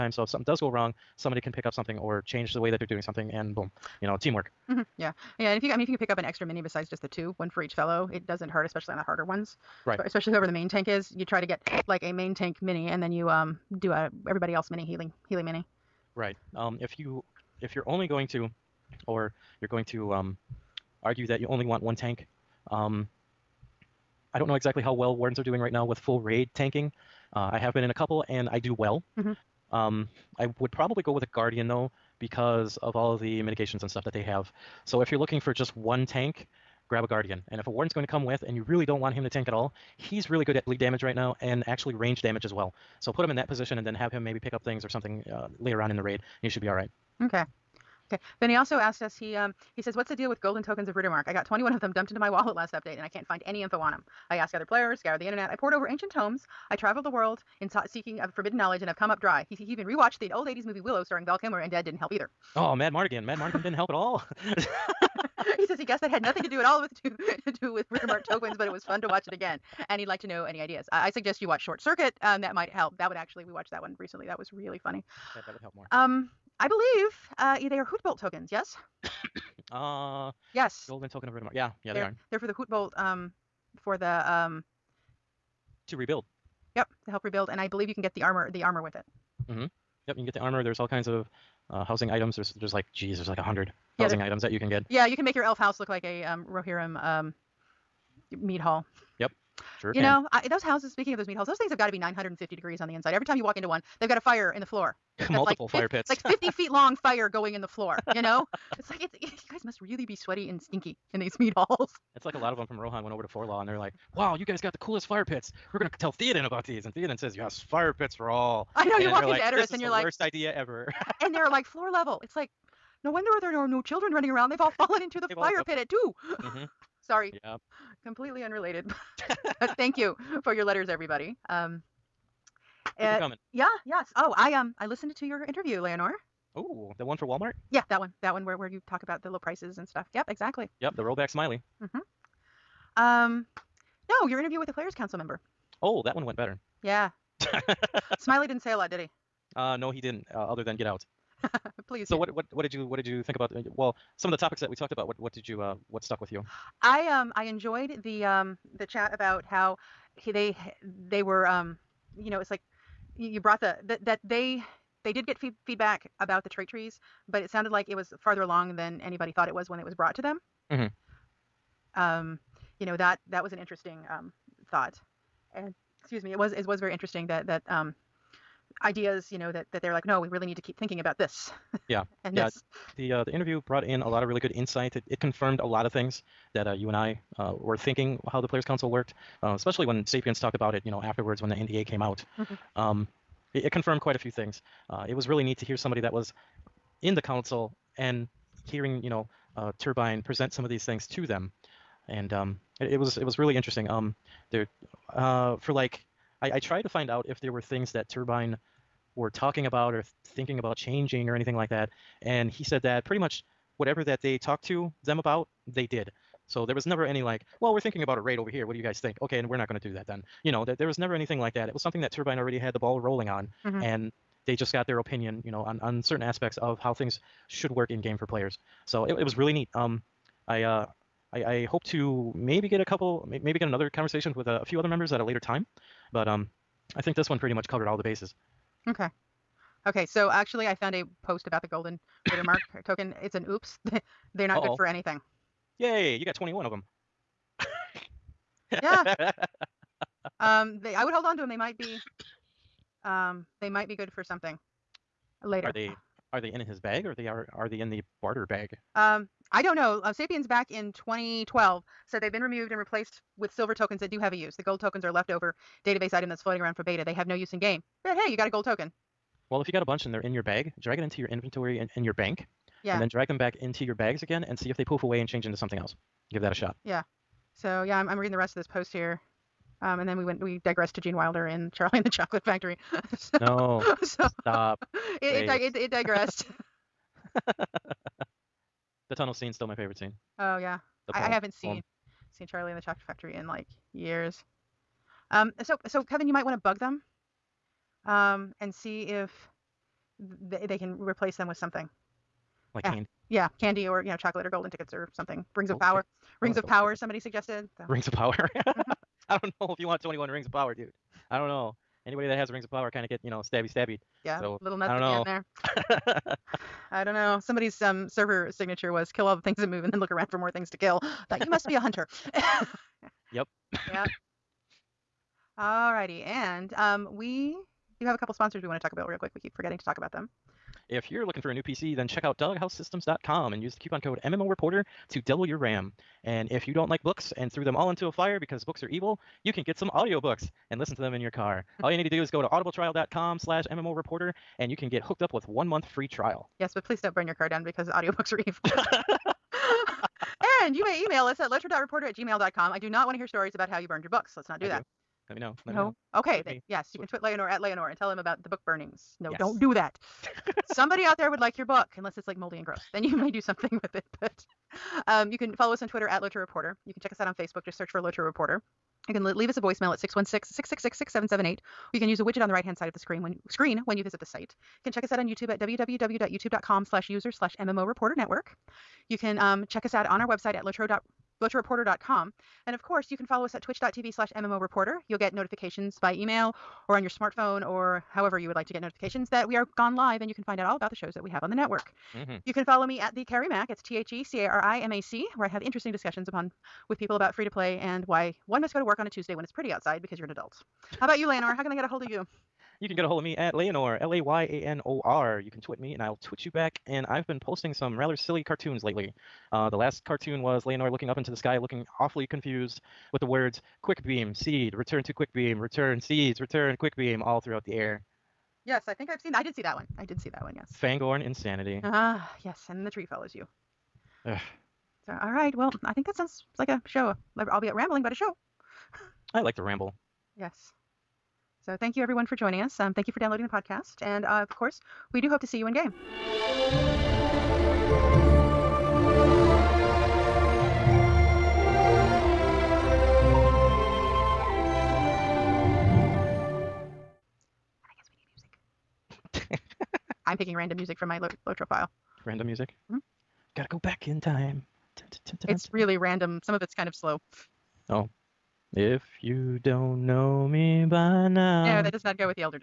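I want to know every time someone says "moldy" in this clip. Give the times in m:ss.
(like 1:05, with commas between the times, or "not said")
6:02.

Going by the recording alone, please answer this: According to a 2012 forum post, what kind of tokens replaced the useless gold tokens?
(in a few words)
silver tokens.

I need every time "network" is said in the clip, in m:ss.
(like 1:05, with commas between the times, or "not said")
6:18, 6:31.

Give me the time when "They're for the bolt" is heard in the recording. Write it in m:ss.
1:22.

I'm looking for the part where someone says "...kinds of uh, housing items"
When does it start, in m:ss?
1:30.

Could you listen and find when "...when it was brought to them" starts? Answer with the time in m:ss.
2:49.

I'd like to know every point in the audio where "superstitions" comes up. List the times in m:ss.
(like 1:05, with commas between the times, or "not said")
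not said.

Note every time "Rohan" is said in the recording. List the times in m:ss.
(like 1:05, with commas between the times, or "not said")
1:52.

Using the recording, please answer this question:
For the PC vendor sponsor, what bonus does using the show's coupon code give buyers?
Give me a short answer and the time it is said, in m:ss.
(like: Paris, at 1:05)
double your RAM, at 5:35.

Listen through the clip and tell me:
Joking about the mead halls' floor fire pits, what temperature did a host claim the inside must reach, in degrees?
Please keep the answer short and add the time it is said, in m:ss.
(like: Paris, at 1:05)
950, at 1:41.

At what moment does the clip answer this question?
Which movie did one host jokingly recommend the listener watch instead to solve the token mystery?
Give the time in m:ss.
1:11.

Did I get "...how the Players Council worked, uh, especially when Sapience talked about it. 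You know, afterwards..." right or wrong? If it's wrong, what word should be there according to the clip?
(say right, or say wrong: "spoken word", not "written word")
right.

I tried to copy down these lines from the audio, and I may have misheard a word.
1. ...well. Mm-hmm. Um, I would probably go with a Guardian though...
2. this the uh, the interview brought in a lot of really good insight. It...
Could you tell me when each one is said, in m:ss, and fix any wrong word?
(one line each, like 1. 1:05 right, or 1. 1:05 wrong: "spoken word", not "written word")
1. 0:28 right
2. 3:02 right.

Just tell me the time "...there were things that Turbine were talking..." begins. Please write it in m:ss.
3:27.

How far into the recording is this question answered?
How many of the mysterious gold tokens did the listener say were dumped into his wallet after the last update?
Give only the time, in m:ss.
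0:51.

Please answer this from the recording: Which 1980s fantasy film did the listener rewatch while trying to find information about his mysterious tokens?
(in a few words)
Willow.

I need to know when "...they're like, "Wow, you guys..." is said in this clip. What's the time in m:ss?
1:53.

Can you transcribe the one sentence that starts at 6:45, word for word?
You can tweet me and I'll tweet you back.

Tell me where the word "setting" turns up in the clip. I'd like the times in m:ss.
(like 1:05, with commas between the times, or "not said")
not said.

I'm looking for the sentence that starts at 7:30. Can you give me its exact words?
I'm picking random music from my lo- Lotro file.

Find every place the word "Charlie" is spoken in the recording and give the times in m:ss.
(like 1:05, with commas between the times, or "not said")
4:41, 4:52.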